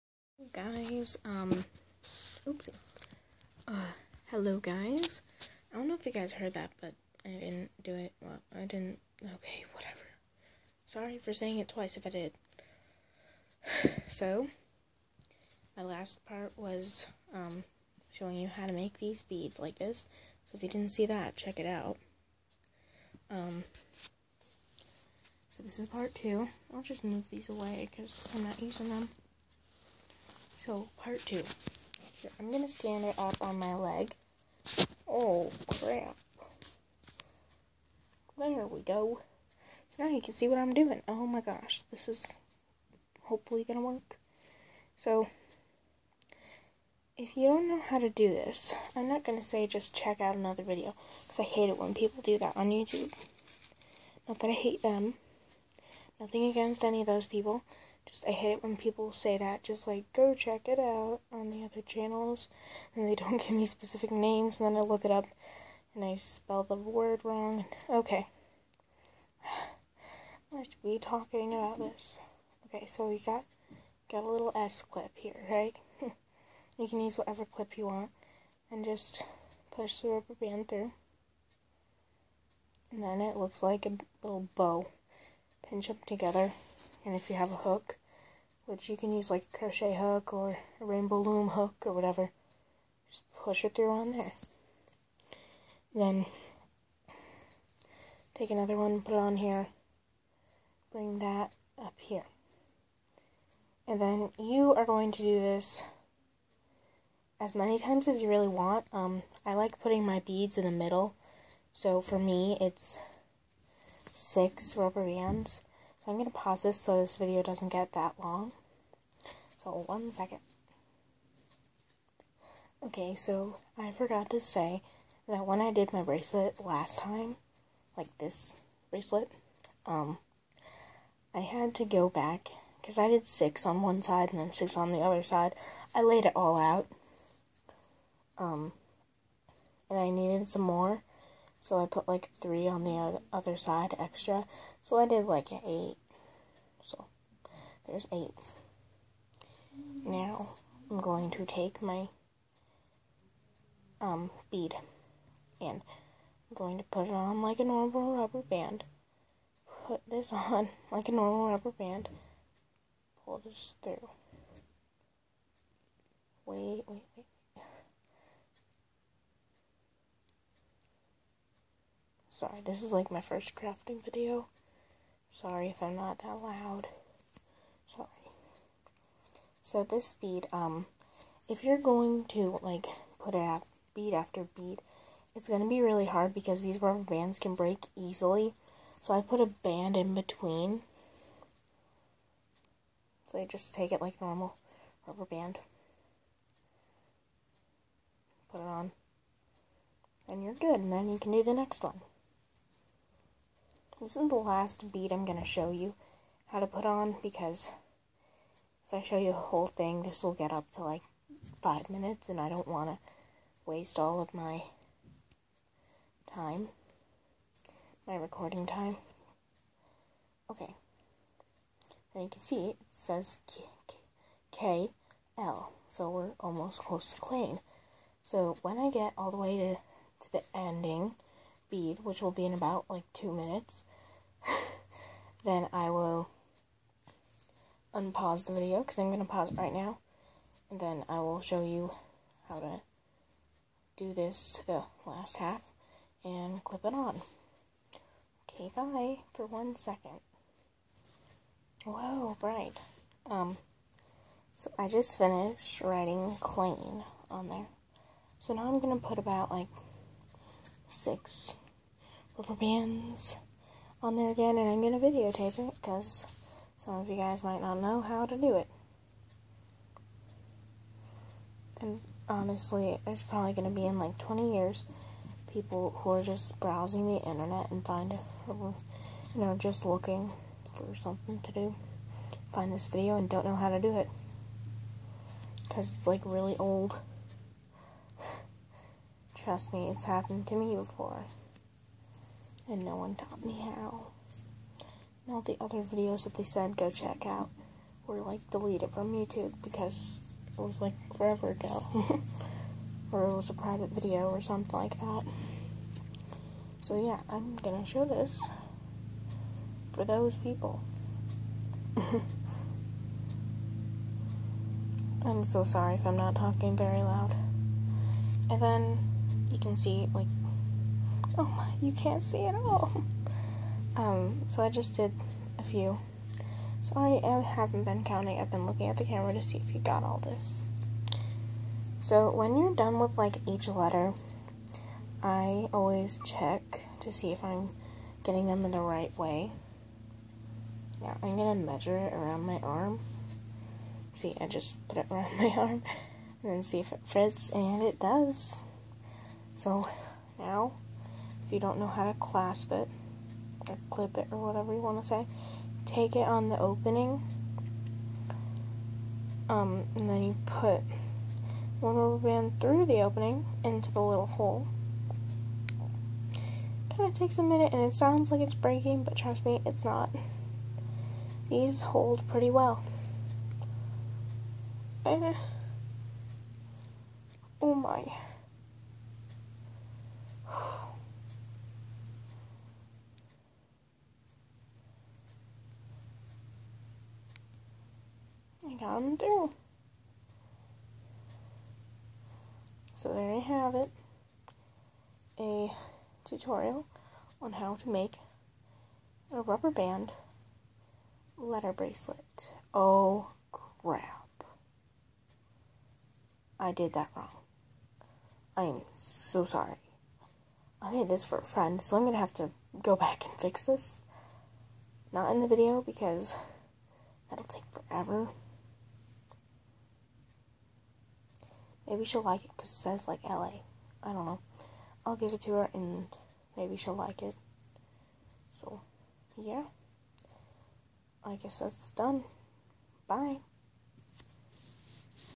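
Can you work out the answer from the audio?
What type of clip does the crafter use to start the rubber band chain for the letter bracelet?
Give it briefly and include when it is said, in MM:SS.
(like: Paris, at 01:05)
S clip, at 01:14.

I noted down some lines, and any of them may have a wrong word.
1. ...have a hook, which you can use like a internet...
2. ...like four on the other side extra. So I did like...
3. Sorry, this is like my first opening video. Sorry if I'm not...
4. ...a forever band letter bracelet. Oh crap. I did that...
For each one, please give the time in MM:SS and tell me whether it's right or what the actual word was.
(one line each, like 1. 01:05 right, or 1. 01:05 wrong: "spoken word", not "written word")
1. 01:27 wrong: "crochet", not "internet"
2. 02:22 wrong: "three", not "four"
3. 02:52 wrong: "crafting", not "opening"
4. 06:39 wrong: "rubber", not "forever".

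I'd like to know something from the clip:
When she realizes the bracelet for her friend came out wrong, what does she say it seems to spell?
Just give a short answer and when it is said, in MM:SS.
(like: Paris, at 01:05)
LA, at 07:03.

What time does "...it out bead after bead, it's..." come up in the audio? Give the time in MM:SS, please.
03:03.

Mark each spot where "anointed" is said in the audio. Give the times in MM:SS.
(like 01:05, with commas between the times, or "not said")
not said.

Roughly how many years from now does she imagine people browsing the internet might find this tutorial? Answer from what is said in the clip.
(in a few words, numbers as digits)
20.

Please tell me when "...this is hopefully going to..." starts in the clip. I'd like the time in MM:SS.
00:41.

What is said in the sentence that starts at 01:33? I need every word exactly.
Just push it through on there.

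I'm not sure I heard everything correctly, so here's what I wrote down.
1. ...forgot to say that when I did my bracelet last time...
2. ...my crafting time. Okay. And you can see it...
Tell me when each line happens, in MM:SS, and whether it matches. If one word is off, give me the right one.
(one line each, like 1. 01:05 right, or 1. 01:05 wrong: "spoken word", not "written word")
1. 02:03 right
2. 03:38 wrong: "recording", not "crafting".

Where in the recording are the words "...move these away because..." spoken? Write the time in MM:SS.
00:27.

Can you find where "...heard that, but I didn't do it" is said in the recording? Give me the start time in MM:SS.
00:06.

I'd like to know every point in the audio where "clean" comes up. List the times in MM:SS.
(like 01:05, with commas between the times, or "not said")
03:47, 04:16.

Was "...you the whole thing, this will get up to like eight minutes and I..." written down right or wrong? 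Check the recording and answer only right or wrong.
wrong.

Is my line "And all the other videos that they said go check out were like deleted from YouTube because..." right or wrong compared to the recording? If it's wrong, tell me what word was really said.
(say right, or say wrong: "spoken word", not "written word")
right.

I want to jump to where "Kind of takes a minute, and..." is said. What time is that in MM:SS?
06:06.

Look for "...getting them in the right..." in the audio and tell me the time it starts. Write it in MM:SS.
05:38.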